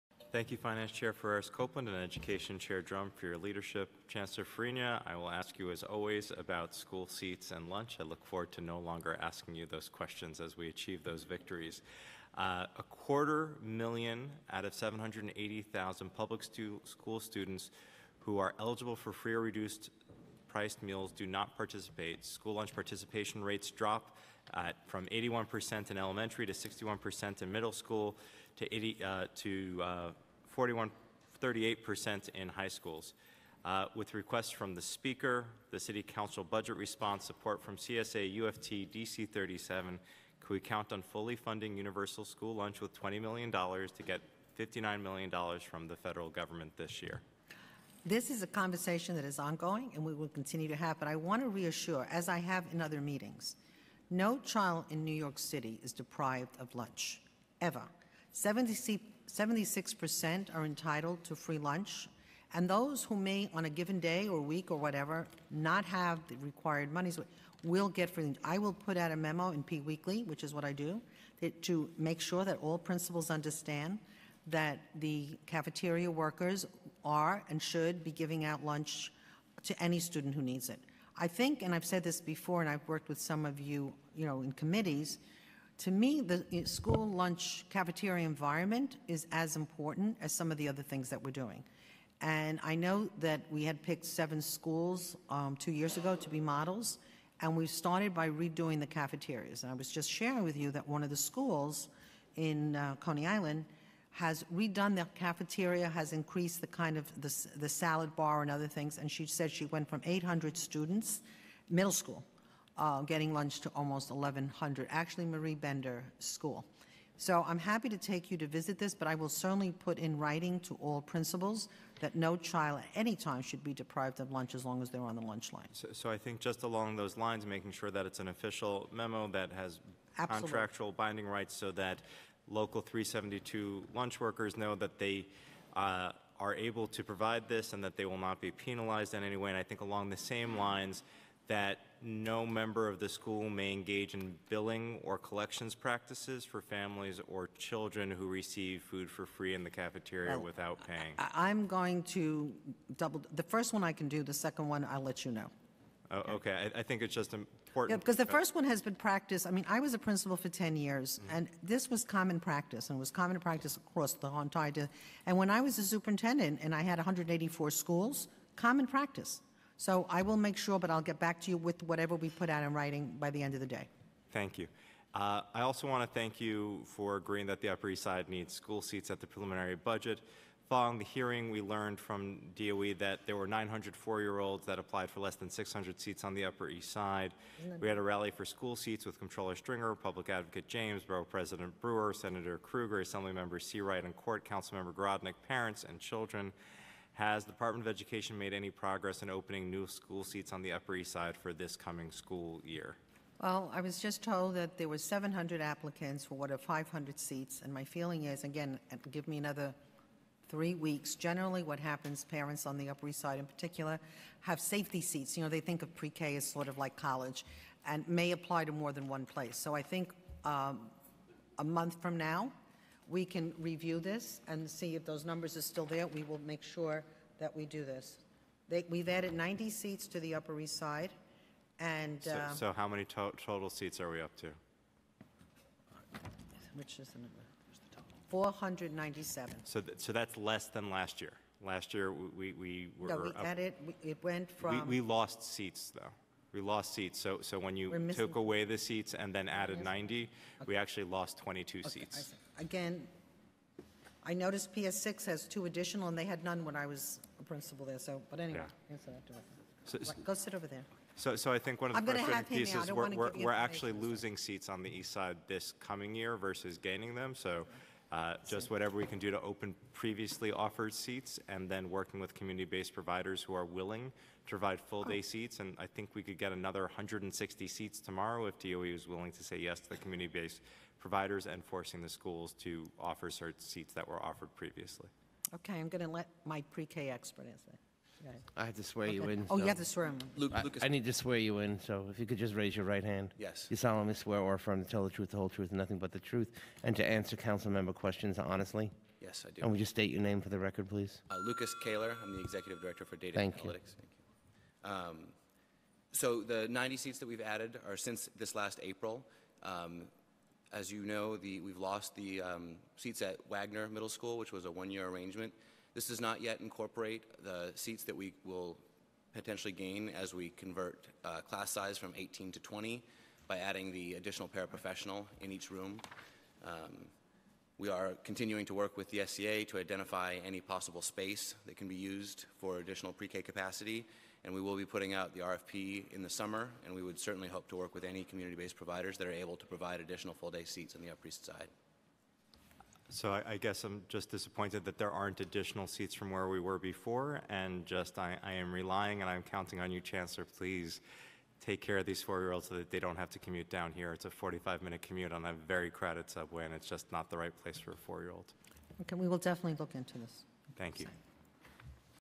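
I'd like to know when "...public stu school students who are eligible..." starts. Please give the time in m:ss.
0:16.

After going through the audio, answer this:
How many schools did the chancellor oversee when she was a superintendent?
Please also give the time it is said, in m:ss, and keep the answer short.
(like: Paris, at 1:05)
184, at 2:46.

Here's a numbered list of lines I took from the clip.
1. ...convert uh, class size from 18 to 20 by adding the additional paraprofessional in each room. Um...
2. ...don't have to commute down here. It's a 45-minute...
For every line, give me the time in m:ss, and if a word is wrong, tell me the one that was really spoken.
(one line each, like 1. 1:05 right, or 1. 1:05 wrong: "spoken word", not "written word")
1. 5:20 right
2. 5:52 right.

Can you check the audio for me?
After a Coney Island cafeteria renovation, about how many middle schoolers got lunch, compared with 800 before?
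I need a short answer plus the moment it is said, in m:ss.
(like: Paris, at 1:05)
1,100, at 1:54.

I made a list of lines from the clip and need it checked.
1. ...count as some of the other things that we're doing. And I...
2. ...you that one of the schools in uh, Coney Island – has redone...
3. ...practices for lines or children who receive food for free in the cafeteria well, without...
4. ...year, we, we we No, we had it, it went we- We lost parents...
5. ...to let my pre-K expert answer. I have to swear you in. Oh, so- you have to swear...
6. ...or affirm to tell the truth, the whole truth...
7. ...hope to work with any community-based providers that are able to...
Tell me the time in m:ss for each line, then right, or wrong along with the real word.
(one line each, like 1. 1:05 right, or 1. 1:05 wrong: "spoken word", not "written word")
1. 1:29 wrong: "important", not "count"
2. 1:40 right
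3. 2:25 wrong: "families", not "lines"
4. 4:01 wrong: "seats", not "parents"
5. 4:46 right
6. 4:54 right
7. 5:37 right.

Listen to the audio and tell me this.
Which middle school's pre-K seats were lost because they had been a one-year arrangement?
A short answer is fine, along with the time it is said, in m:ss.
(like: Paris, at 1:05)
Wagner Middle School, at 5:13.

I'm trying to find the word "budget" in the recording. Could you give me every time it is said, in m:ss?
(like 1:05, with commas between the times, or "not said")
0:36, 2:59.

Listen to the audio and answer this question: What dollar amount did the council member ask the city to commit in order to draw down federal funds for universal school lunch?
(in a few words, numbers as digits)
$20 million.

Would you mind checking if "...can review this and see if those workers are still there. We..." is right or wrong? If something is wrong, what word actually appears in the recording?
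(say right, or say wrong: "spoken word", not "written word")
wrong: "numbers", not "workers".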